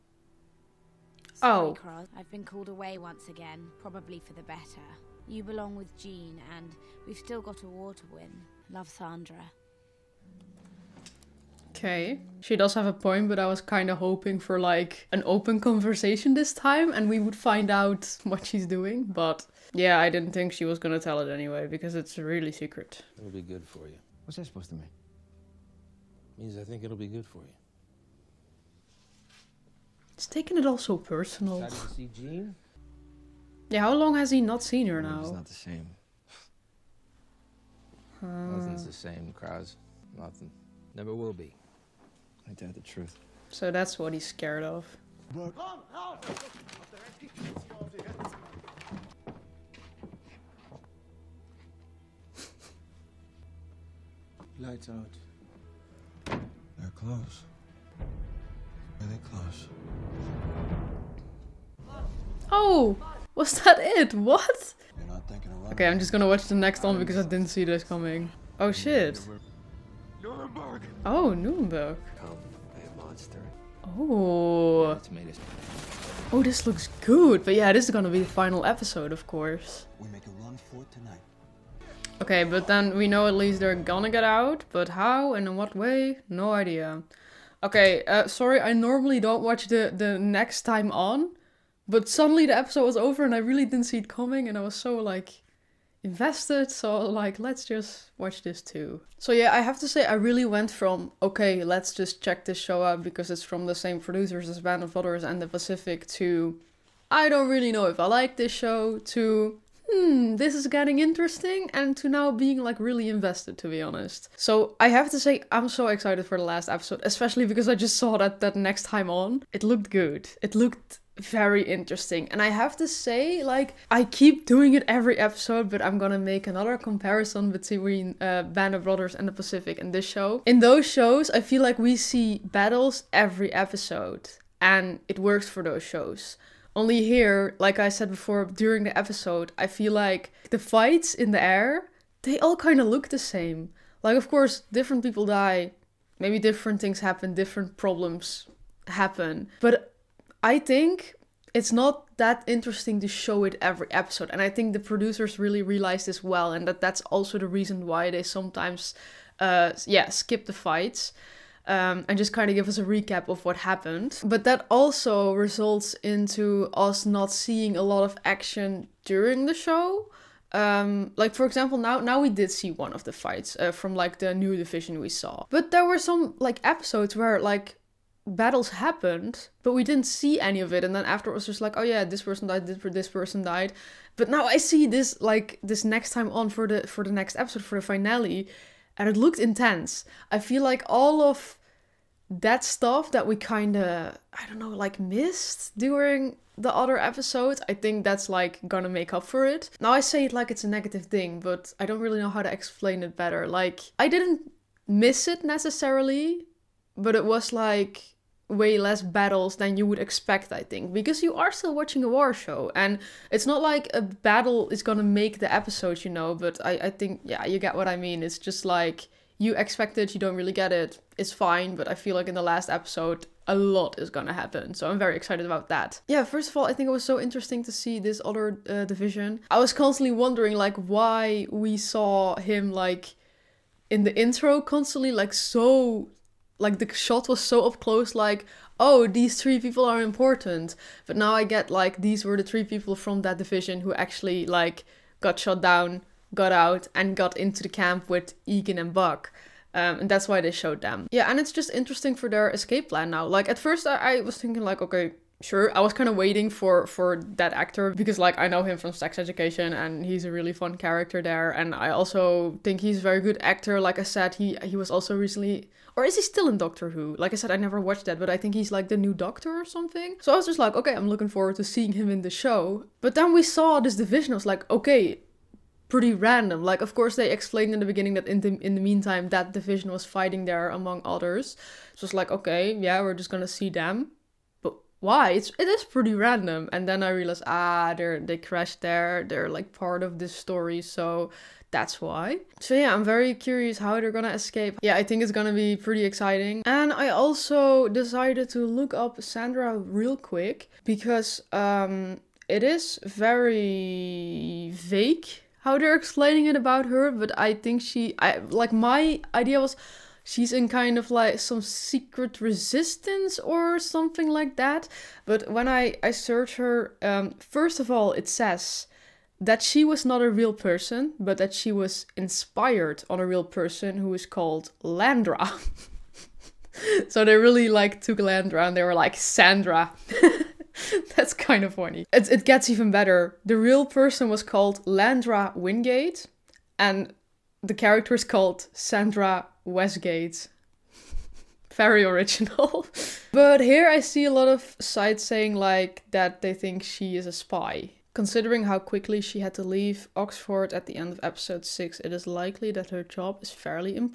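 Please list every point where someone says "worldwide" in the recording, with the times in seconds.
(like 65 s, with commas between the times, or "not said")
not said.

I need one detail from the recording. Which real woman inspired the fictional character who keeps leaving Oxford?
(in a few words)
Landra Wingate.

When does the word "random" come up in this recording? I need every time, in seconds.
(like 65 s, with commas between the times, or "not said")
276 s, 286 s.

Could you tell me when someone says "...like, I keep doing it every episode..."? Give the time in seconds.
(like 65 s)
123 s.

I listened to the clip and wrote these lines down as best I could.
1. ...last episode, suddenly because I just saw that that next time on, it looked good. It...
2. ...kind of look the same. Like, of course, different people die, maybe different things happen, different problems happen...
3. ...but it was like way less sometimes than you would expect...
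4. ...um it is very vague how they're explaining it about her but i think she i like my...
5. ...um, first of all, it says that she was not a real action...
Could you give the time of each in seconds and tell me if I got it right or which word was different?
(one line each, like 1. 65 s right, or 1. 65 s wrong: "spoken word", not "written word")
1. 116 s wrong: "especially", not "suddenly"
2. 142 s right
3. 206 s wrong: "battles", not "sometimes"
4. 301 s right
5. 317 s wrong: "person", not "action".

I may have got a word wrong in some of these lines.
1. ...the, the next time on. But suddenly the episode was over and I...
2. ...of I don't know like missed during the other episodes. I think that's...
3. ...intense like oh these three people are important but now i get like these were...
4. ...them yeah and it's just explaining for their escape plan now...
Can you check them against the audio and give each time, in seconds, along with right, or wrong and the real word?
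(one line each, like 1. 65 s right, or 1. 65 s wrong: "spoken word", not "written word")
1. 89 s right
2. 193 s right
3. 237 s wrong: "close", not "intense"
4. 250 s wrong: "interesting", not "explaining".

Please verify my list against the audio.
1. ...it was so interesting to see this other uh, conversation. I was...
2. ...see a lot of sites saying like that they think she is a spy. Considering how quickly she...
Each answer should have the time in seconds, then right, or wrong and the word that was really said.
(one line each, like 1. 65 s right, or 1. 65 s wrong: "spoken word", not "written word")
1. 226 s wrong: "division", not "conversation"
2. 343 s right.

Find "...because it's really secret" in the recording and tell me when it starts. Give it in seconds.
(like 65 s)
21 s.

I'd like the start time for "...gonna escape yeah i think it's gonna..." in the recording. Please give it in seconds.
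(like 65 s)
294 s.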